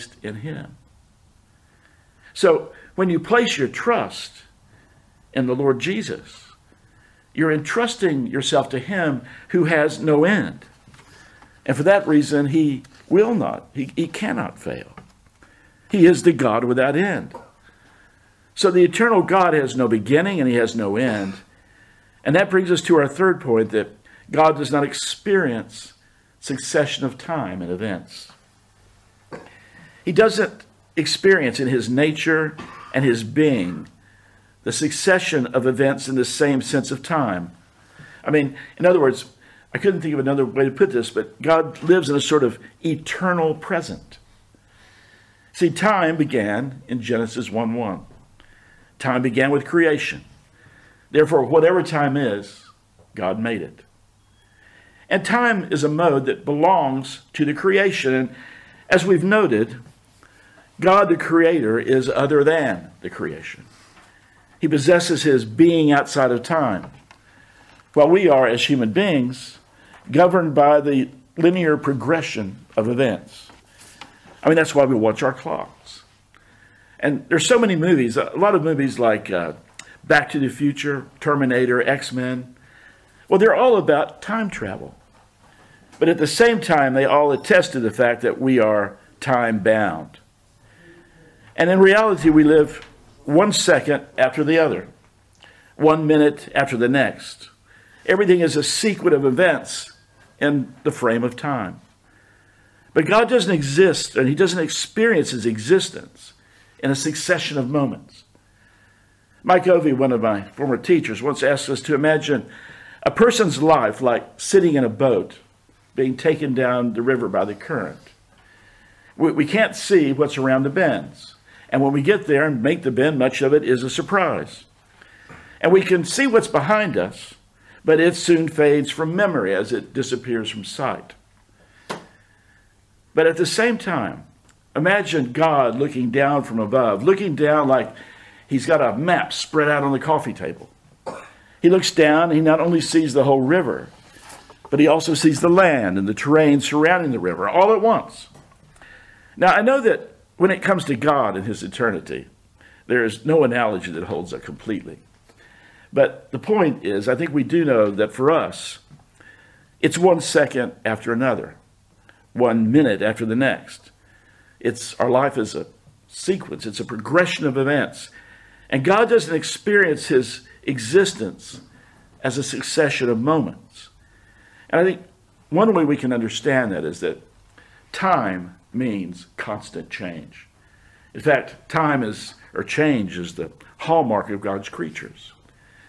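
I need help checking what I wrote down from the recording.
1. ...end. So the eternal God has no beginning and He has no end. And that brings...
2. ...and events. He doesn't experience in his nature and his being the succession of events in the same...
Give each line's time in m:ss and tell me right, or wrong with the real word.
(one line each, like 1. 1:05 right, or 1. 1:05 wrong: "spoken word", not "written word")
1. 0:16 right
2. 0:27 right.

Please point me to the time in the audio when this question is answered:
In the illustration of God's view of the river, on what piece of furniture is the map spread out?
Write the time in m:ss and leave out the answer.
2:19.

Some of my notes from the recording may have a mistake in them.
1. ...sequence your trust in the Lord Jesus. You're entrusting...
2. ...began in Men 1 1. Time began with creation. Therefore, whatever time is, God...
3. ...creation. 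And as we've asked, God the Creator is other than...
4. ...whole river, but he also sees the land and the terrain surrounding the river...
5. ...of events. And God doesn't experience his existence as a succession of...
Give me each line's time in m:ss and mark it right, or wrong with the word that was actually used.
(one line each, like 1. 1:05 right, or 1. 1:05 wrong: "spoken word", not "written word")
1. 0:03 wrong: "place", not "sequence"
2. 0:46 wrong: "Genesis", not "Men"
3. 0:57 wrong: "noted", not "asked"
4. 2:23 right
5. 2:47 right.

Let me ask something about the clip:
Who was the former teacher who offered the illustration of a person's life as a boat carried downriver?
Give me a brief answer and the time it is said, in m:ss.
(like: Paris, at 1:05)
Mike Ovey, at 1:49.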